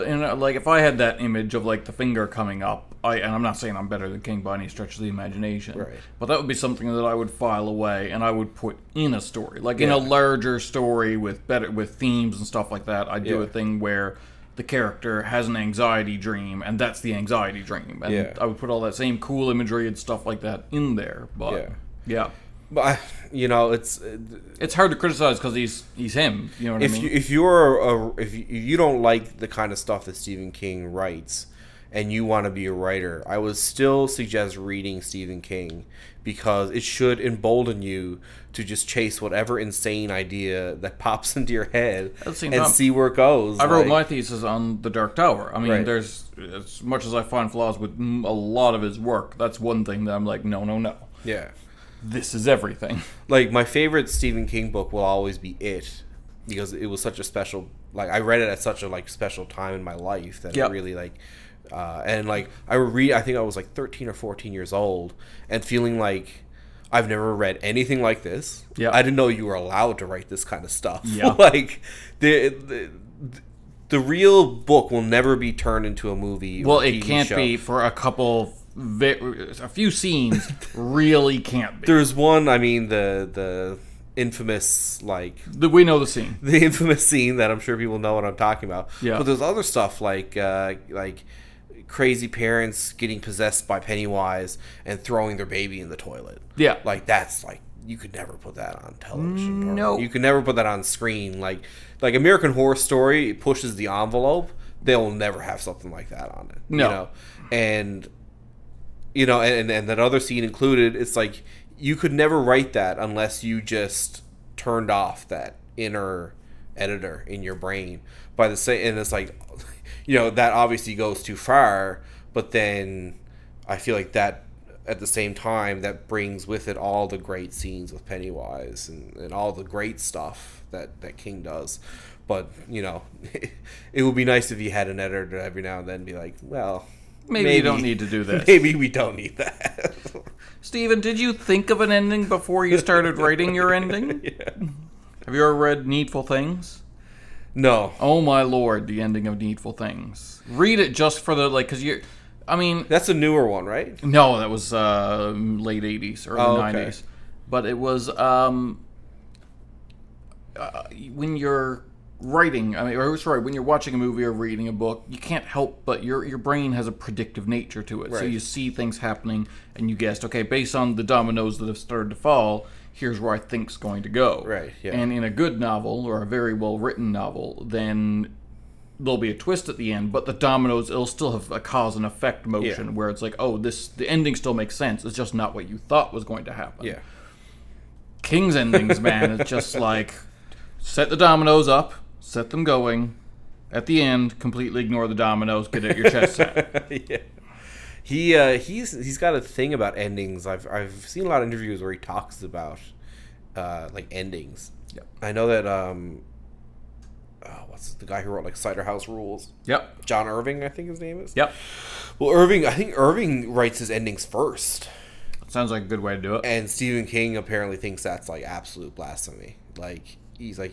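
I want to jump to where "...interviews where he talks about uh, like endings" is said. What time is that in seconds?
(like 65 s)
201 s.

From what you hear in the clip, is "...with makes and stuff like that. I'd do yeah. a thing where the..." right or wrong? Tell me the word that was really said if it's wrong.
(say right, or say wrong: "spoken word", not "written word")
wrong: "themes", not "makes".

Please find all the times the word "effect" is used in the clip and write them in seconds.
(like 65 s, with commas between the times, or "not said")
182 s.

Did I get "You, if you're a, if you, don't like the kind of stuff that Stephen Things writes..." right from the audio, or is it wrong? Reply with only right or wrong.
wrong.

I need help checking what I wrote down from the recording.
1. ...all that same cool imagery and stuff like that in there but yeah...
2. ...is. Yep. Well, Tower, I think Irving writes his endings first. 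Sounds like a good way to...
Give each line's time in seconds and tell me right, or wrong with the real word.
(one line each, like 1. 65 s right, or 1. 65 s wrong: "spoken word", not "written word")
1. 18 s right
2. 211 s wrong: "Irving", not "Tower".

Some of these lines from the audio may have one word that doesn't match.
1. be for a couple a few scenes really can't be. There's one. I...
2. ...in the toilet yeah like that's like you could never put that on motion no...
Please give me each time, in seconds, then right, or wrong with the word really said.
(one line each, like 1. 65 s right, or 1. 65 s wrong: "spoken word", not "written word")
1. 77 s right
2. 95 s wrong: "television", not "motion".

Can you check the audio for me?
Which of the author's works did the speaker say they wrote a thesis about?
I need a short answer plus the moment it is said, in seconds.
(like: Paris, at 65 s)
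The Dark Tower, at 44 s.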